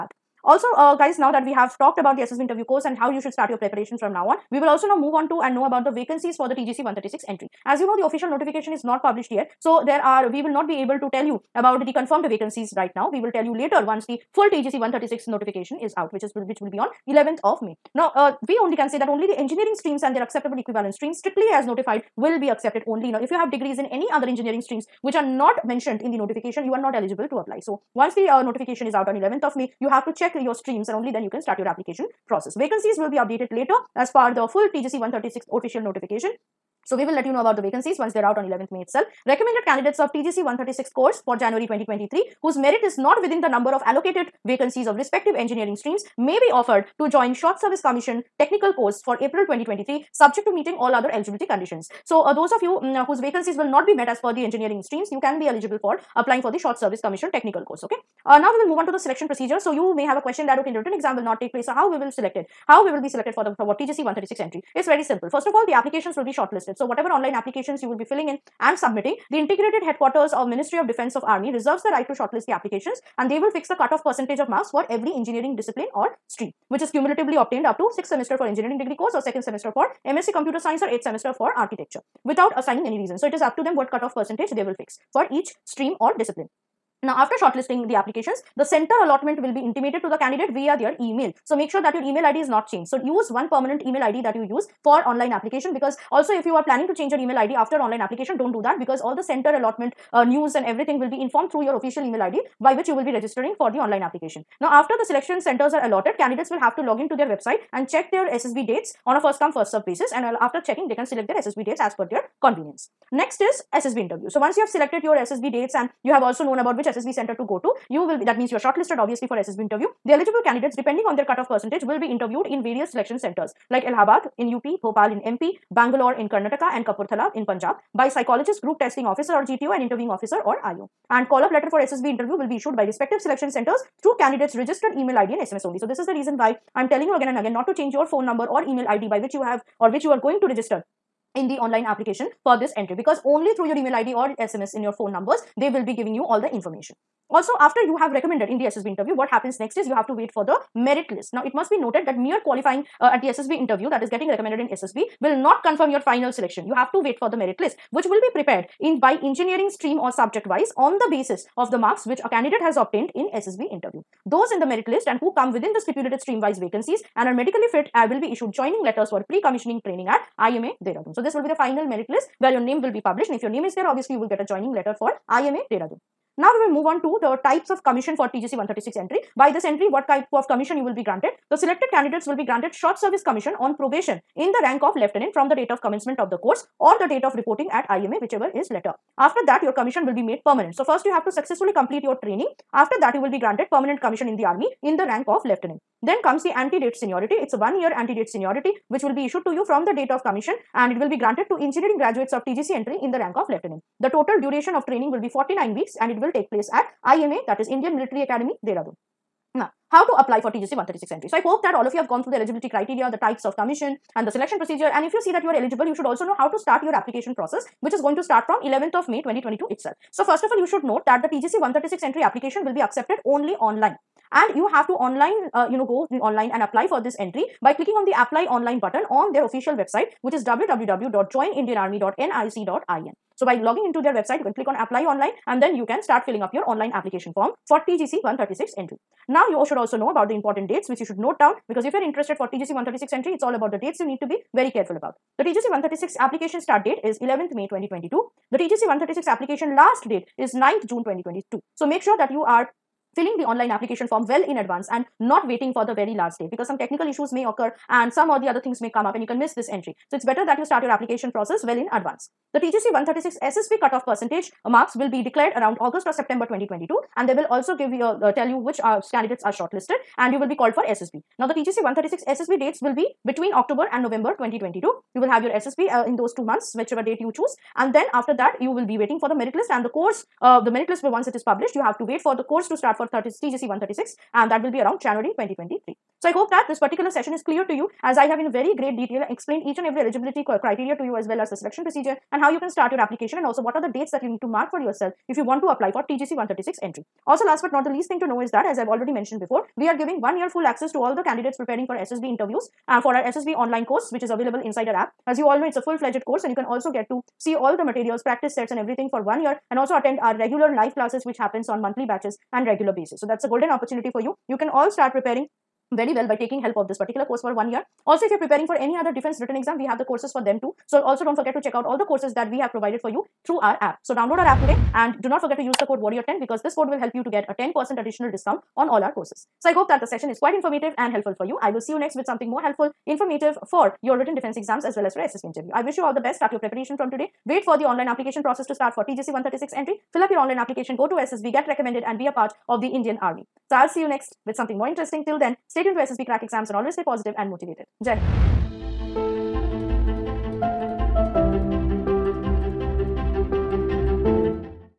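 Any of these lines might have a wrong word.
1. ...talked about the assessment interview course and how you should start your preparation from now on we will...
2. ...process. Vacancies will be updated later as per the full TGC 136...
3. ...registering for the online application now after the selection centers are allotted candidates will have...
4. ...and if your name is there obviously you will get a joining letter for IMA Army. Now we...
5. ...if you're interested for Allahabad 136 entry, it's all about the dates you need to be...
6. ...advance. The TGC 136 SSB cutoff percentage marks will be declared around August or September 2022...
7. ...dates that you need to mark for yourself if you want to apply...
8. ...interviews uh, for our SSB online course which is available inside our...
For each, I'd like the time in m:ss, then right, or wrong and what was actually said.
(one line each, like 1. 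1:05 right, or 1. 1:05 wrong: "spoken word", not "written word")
1. 0:01 right
2. 0:32 right
3. 1:43 right
4. 2:53 wrong: "Dehradun", not "Army"
5. 4:01 wrong: "TGC", not "Allahabad"
6. 4:21 right
7. 4:53 right
8. 5:02 right.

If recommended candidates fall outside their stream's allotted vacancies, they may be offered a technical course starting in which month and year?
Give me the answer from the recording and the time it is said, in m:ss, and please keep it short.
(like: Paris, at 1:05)
April 2023, at 0:49.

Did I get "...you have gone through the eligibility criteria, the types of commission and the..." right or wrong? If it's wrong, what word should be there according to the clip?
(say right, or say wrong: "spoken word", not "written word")
right.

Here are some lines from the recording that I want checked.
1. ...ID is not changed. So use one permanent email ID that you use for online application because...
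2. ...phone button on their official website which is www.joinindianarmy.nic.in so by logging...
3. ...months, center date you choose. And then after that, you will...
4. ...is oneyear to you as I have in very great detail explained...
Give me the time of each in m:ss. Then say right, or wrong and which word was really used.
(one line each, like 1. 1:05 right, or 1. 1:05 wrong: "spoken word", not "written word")
1. 1:32 right
2. 3:48 wrong: "online", not "phone"
3. 4:36 wrong: "whichever", not "center"
4. 4:47 wrong: "clear", not "oneyear".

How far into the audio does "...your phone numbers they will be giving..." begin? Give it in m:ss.
2:24.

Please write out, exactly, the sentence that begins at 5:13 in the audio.
So that's a golden opportunity for you.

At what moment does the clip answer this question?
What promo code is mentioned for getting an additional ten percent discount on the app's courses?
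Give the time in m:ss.
5:25.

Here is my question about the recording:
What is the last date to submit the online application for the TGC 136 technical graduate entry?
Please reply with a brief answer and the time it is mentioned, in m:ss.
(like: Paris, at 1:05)
9 June 2022, at 4:10.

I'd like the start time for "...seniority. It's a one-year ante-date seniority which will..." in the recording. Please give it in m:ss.
3:16.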